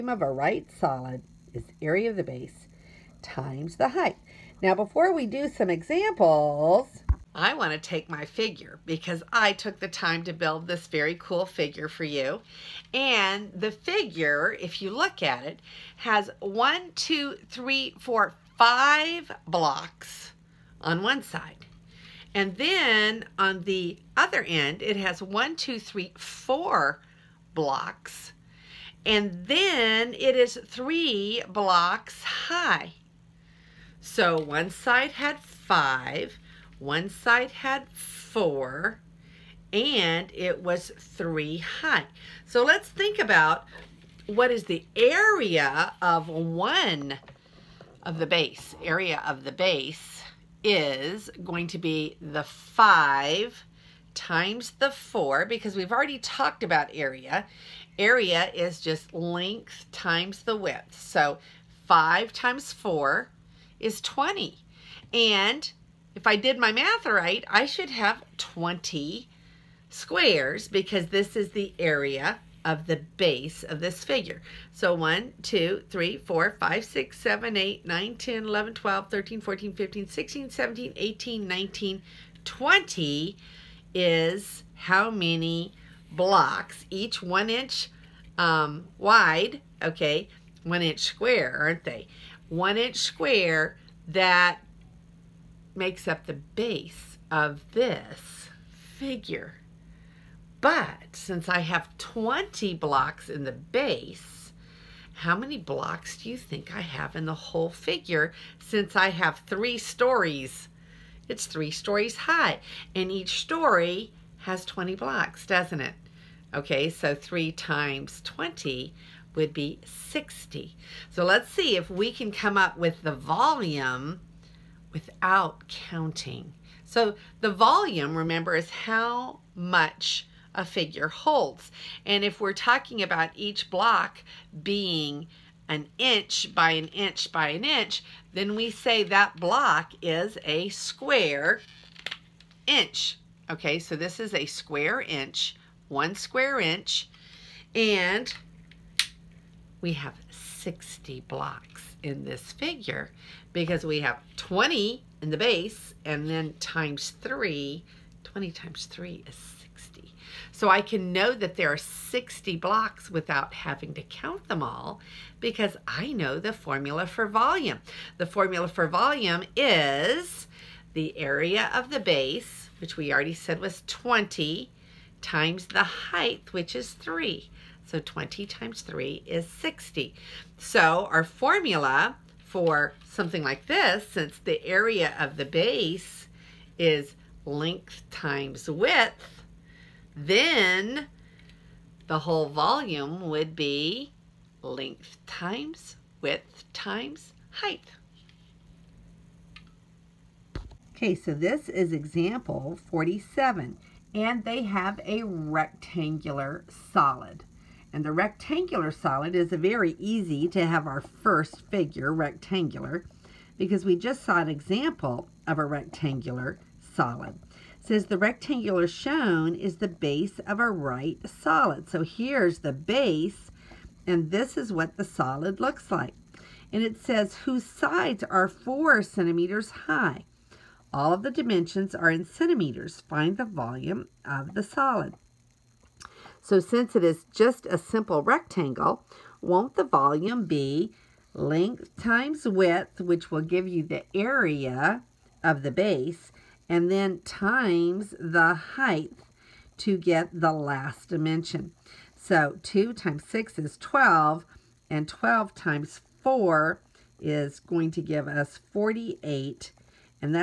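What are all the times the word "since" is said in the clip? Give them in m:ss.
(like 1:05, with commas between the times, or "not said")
1:41, 1:48, 3:04, 3:56.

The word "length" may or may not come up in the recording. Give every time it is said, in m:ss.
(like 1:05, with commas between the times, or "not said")
0:59, 3:07, 3:14, 4:01.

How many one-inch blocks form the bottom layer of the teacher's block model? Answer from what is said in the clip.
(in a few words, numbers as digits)
20.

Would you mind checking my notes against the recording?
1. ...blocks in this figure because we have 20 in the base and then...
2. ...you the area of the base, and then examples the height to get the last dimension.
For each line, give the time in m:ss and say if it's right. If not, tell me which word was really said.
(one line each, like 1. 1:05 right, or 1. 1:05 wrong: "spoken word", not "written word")
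1. 2:31 right
2. 4:03 wrong: "times", not "examples".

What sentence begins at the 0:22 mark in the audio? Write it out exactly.
And then on the other end, it has one, two, three, four blocks.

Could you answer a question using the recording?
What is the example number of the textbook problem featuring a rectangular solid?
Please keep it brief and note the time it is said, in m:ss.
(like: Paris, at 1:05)
47, at 3:21.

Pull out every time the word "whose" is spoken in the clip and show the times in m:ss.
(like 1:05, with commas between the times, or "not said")
3:47.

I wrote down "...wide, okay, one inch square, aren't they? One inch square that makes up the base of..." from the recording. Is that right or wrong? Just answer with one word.
right.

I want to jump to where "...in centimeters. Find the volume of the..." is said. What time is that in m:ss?
3:52.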